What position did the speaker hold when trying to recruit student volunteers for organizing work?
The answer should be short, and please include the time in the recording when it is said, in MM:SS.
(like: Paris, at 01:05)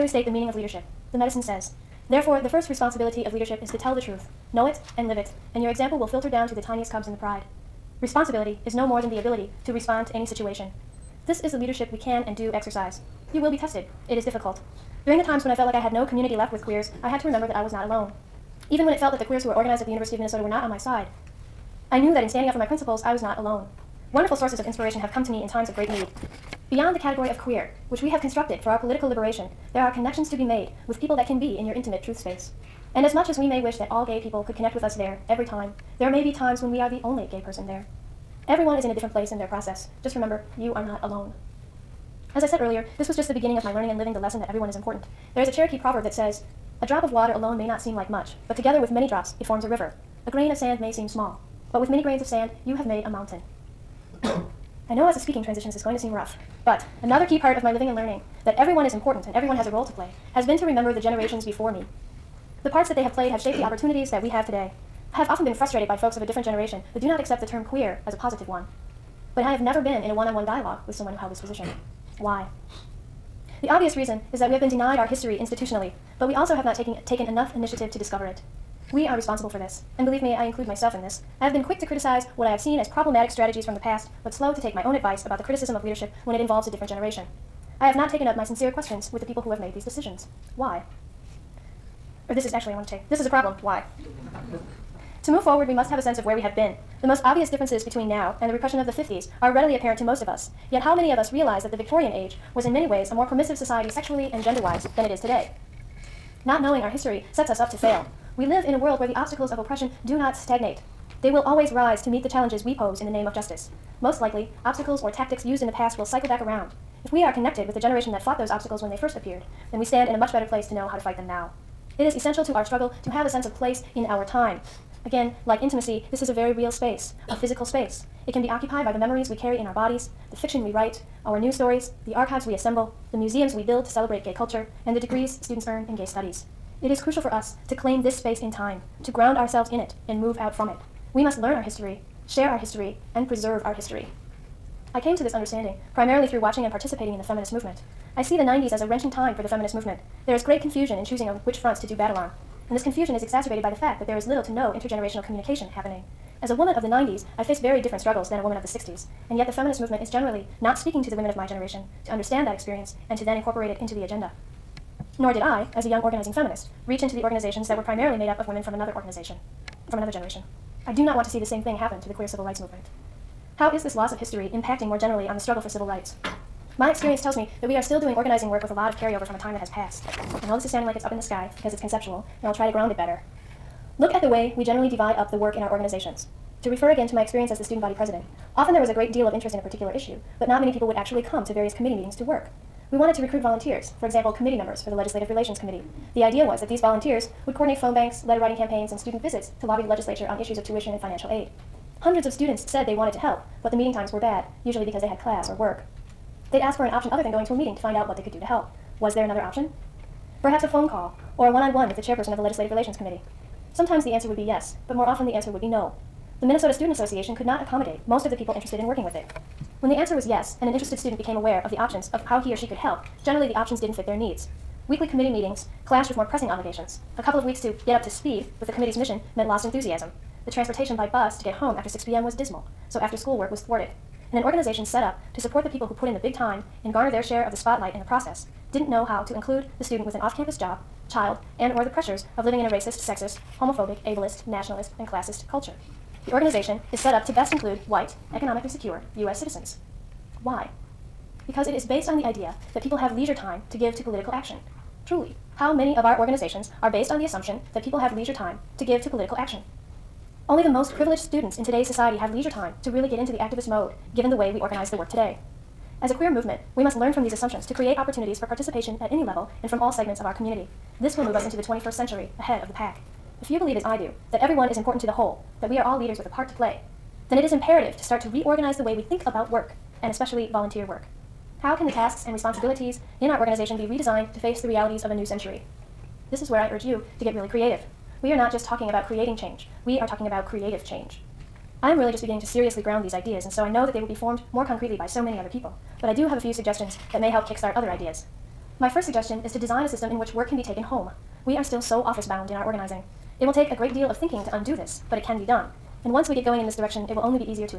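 student body president, at 03:07.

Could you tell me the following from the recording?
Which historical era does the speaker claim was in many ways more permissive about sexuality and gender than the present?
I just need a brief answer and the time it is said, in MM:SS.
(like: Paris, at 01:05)
Victorian age, at 01:41.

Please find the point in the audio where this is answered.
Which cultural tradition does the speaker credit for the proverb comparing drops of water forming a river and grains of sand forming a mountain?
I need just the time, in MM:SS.
00:45.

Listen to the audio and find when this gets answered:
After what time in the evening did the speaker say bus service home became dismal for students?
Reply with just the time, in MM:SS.
03:51.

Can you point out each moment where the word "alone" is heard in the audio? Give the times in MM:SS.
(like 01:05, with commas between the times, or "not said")
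00:17, 00:23, 00:41, 00:47.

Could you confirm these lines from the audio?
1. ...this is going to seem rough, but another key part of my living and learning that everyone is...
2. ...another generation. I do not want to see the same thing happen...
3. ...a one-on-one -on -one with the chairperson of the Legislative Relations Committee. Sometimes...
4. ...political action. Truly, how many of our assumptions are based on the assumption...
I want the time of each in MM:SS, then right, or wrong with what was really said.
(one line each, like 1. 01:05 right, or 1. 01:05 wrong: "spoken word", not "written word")
1. 00:55 right
2. 02:49 right
3. 03:31 right
4. 04:14 wrong: "organizations", not "assumptions".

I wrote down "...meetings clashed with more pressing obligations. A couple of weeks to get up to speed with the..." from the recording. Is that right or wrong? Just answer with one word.
right.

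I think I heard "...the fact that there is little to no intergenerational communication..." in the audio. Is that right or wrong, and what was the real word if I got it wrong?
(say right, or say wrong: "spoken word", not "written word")
right.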